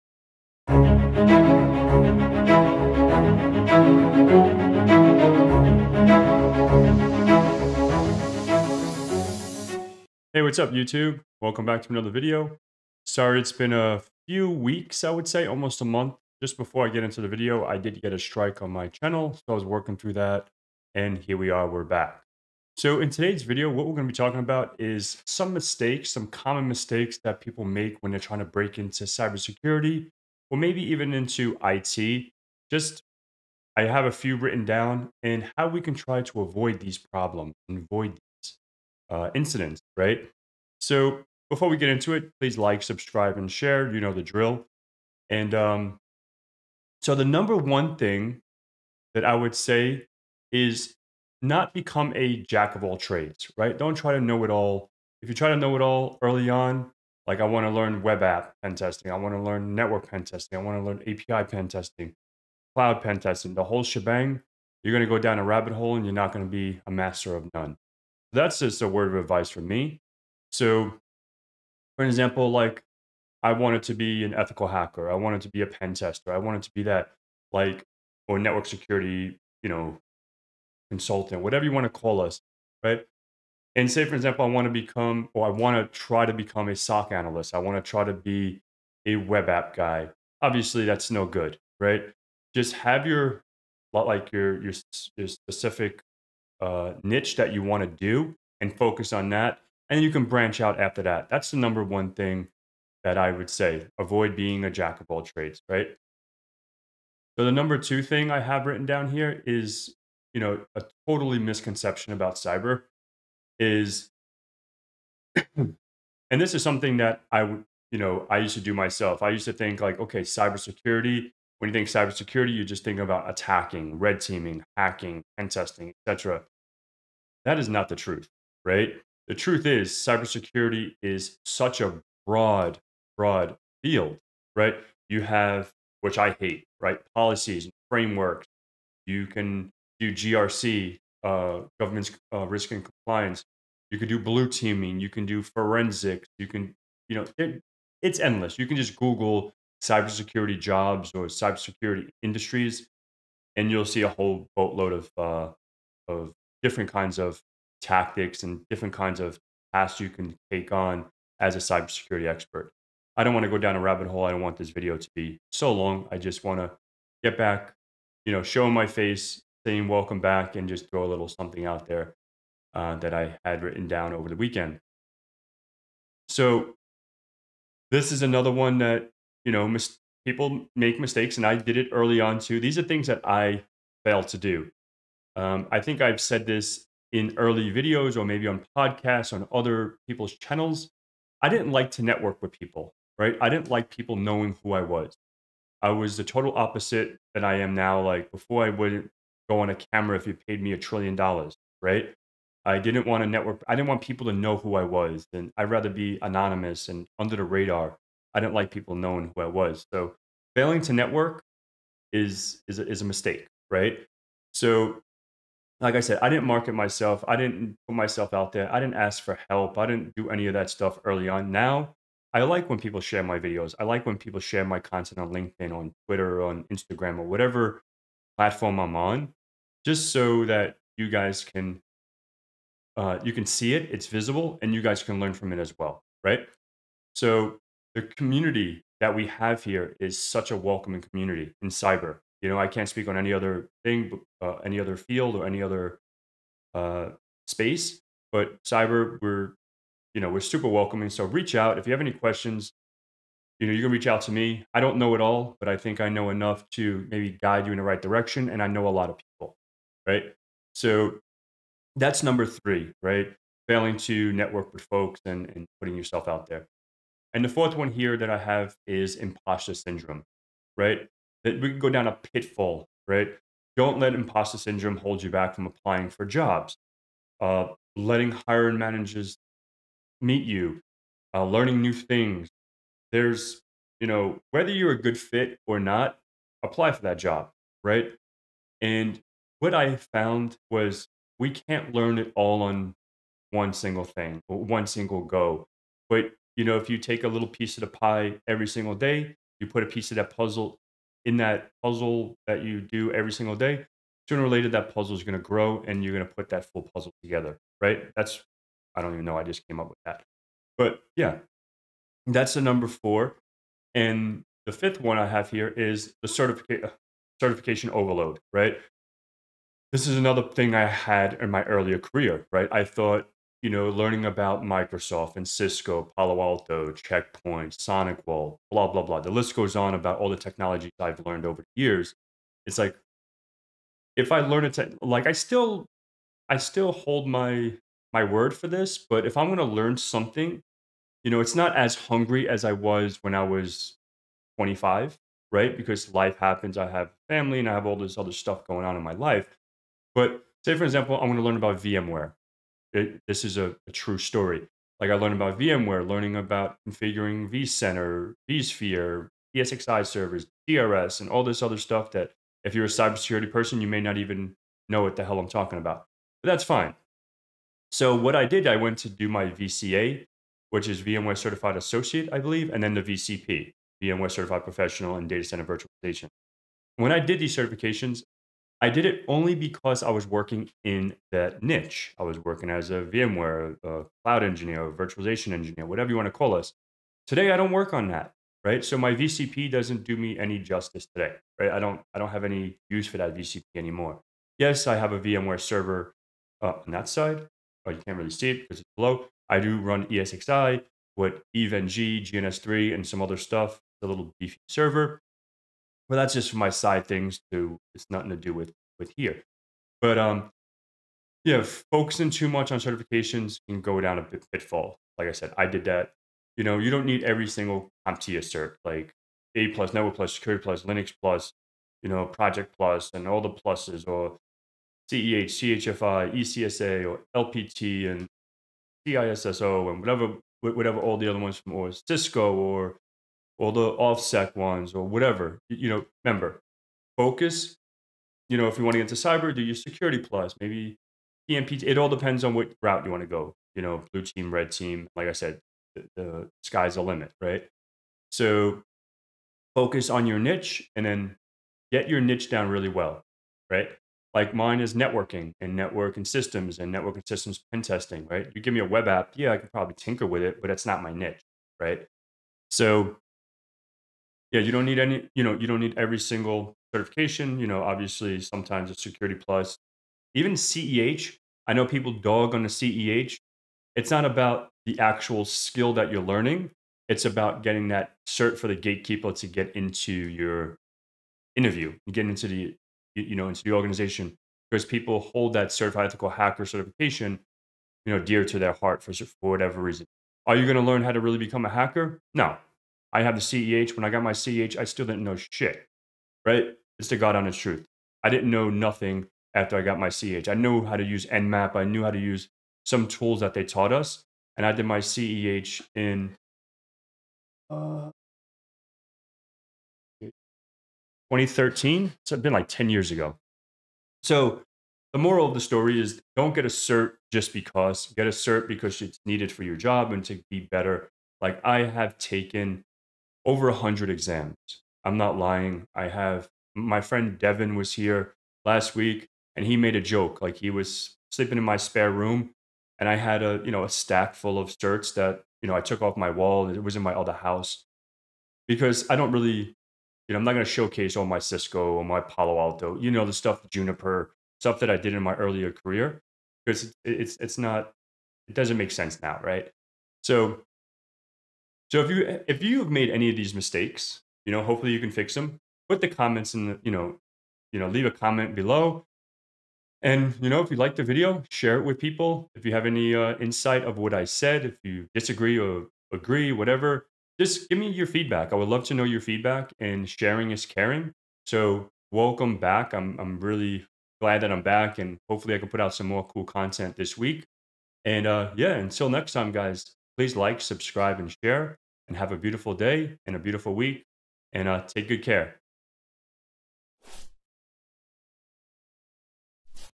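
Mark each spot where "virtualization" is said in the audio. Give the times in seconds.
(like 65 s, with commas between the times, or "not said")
375 s, 384 s.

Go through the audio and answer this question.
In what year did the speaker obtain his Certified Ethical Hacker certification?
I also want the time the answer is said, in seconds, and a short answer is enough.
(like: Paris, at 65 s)
2013, at 510 s.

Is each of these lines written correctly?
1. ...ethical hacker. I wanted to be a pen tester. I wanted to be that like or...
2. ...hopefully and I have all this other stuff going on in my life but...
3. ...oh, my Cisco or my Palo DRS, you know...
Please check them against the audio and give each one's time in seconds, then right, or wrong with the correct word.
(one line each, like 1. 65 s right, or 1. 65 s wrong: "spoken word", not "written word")
1. 74 s right
2. 347 s wrong: "family", not "hopefully"
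3. 541 s wrong: "Alto", not "DRS".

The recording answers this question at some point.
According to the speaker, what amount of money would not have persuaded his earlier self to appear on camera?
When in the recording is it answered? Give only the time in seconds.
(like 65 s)
200 s.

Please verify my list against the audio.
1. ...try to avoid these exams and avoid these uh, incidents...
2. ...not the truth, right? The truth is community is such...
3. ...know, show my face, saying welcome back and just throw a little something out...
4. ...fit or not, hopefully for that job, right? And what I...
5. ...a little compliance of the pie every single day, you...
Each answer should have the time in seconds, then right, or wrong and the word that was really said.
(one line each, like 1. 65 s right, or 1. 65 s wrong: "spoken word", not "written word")
1. 35 s wrong: "problems", not "exams"
2. 127 s wrong: "cybersecurity", not "community"
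3. 168 s right
4. 285 s wrong: "apply", not "hopefully"
5. 297 s wrong: "piece", not "compliance".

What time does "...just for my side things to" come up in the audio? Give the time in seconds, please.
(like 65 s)
406 s.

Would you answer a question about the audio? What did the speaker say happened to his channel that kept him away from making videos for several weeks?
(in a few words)
A strike.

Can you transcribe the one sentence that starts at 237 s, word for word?
So the community that we have here is such a welcoming community in cyber.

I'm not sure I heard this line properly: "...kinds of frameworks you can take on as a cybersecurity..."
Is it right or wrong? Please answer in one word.
wrong.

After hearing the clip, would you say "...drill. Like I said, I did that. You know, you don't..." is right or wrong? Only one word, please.
wrong.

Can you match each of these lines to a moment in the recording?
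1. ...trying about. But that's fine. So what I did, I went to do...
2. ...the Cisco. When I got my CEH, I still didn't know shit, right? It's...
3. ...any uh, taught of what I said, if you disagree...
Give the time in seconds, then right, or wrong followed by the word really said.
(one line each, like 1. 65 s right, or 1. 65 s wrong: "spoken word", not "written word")
1. 365 s wrong: "talking", not "trying"
2. 493 s wrong: "CEH", not "Cisco"
3. 562 s wrong: "insight", not "taught".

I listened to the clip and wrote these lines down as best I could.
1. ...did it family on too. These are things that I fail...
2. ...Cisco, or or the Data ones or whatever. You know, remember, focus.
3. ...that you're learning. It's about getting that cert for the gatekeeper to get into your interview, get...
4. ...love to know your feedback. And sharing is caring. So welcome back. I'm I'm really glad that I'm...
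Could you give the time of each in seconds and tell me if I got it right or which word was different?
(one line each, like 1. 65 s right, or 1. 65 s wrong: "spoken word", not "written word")
1. 181 s wrong: "early", not "family"
2. 432 s wrong: "OffSec", not "Data"
3. 475 s right
4. 568 s right.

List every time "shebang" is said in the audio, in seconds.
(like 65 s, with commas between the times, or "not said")
63 s.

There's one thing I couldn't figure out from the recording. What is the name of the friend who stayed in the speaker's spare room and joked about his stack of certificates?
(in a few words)
Devin.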